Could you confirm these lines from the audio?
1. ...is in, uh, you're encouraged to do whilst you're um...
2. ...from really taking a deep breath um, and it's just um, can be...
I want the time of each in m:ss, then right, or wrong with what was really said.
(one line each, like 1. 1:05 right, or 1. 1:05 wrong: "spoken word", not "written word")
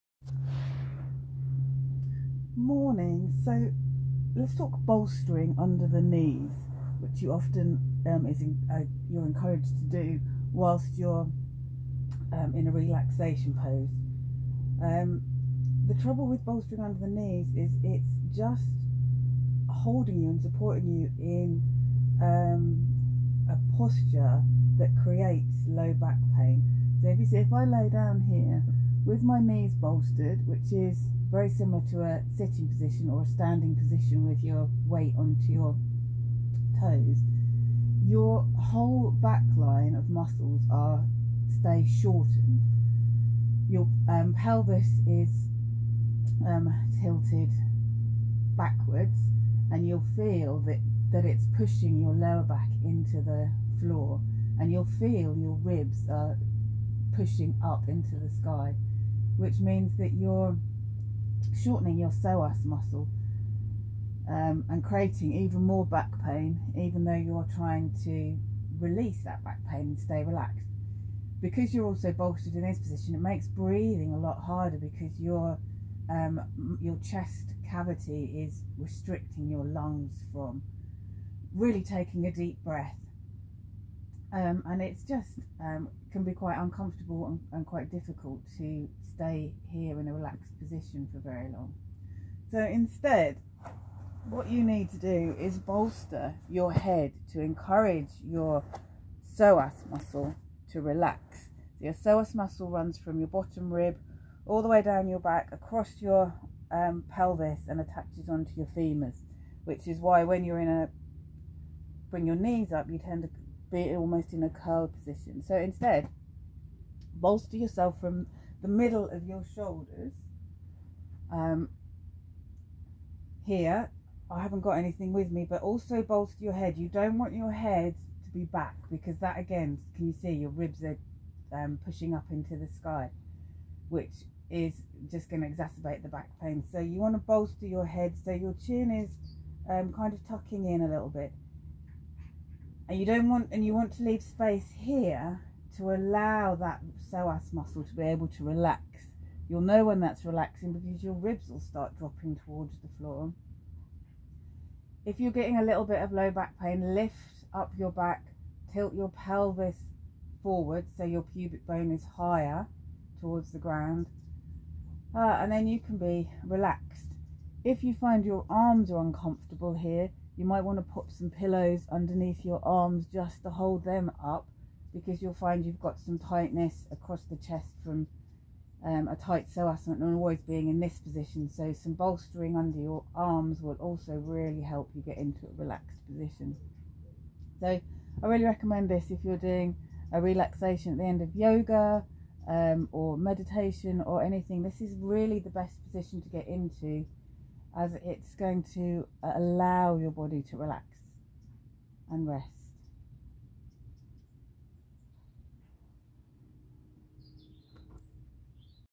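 1. 0:08 right
2. 1:20 right.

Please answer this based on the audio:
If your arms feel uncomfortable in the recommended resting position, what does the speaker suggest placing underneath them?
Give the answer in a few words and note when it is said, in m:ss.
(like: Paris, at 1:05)
pillows, at 2:51.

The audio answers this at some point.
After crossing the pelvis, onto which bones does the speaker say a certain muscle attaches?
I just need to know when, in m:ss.
1:48.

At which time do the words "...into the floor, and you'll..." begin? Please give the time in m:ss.
0:52.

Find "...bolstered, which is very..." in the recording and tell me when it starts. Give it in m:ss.
0:29.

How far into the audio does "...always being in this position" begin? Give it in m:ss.
3:00.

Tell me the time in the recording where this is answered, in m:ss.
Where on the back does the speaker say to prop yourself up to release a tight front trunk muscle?
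1:58.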